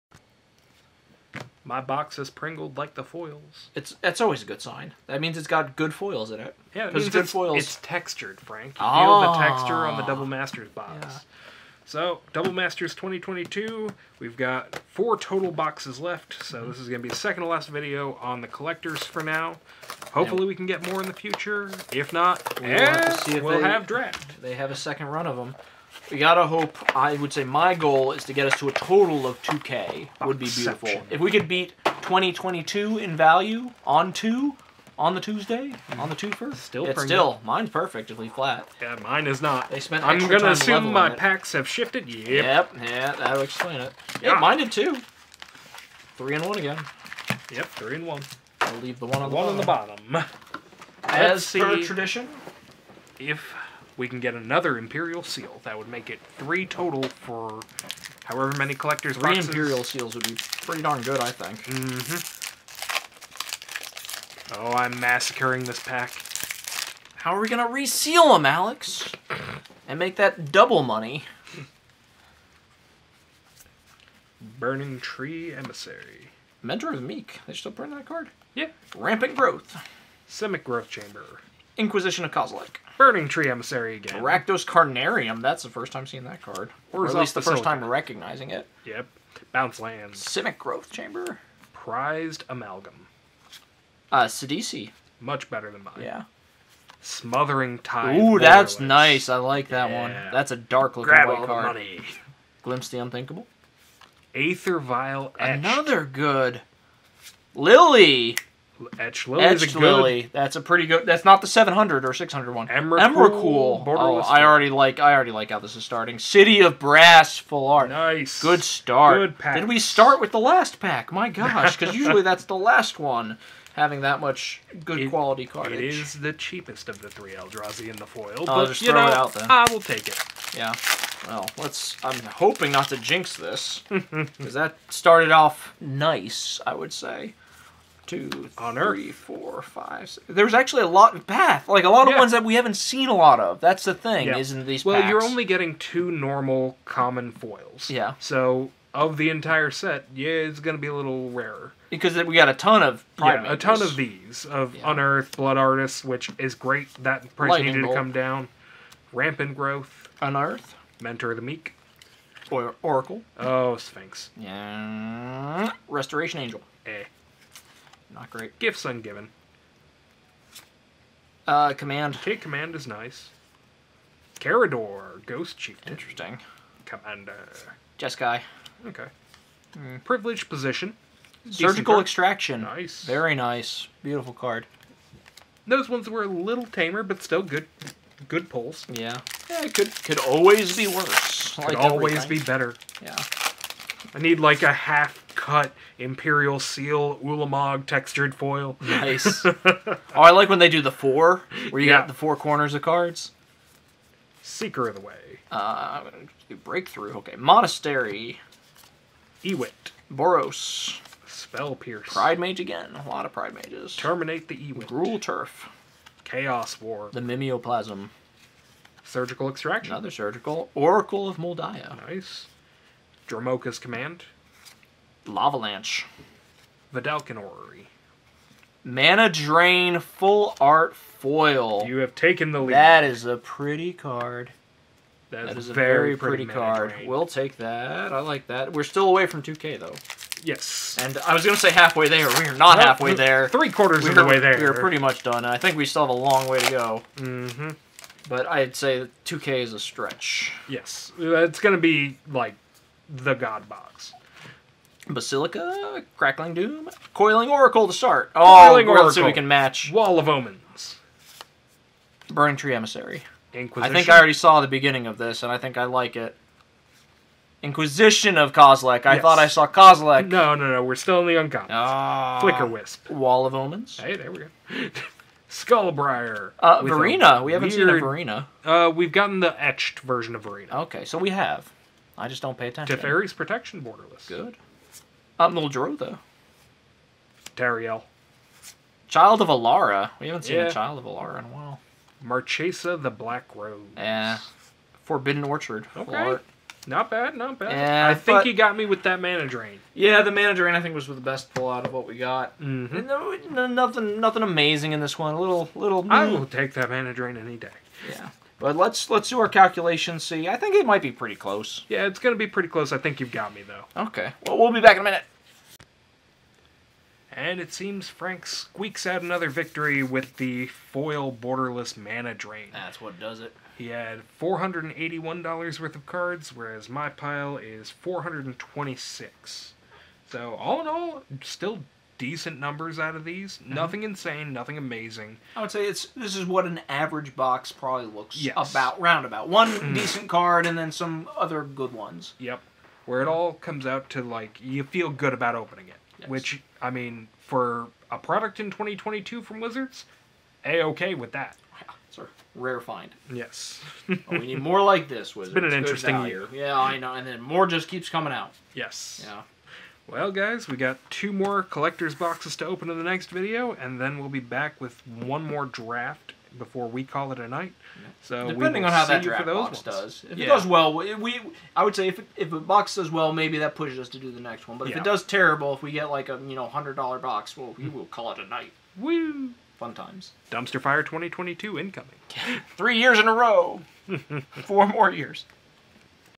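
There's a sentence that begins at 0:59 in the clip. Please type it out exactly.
Imperial Seals would be pretty darn good, I think.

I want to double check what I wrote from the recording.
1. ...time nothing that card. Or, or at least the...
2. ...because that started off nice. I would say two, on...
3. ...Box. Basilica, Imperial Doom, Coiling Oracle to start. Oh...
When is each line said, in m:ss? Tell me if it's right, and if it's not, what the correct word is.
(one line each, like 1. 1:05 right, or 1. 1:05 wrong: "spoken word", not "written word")
1. 1:25 wrong: "seeing", not "nothing"
2. 2:13 right
3. 4:13 wrong: "Crackling", not "Imperial".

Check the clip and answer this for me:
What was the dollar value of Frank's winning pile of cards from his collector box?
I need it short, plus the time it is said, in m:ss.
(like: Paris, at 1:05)
$481, at 5:24.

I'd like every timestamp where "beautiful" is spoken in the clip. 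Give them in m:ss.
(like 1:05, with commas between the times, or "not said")
0:30, 3:04.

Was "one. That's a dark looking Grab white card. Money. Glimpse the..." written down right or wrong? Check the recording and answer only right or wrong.
right.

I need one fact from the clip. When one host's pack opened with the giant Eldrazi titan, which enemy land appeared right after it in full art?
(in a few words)
City of Brass.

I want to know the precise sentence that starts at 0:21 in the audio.
If not, we'll, have, we'll they, have draft.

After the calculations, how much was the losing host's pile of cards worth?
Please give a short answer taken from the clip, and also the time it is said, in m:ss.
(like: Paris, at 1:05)
426, at 5:27.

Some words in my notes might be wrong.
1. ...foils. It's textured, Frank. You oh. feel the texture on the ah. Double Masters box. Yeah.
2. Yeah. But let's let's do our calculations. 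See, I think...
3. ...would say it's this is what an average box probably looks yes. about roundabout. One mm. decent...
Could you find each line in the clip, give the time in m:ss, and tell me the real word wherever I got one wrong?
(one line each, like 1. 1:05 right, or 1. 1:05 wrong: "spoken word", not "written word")
1. 0:07 right
2. 5:08 right
3. 5:35 right.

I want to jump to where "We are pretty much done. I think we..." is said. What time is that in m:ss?
4:04.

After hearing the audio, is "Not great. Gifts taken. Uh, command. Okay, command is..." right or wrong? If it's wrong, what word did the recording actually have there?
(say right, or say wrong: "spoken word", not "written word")
wrong: "ungiven", not "taken".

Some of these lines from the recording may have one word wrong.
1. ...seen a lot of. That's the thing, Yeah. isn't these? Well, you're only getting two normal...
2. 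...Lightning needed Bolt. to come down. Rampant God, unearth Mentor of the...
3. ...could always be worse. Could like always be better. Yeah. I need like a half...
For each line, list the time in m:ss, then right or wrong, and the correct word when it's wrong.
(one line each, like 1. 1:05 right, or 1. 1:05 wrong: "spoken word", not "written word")
1. 2:22 right
2. 2:37 wrong: "Growth", not "God"
3. 3:10 right.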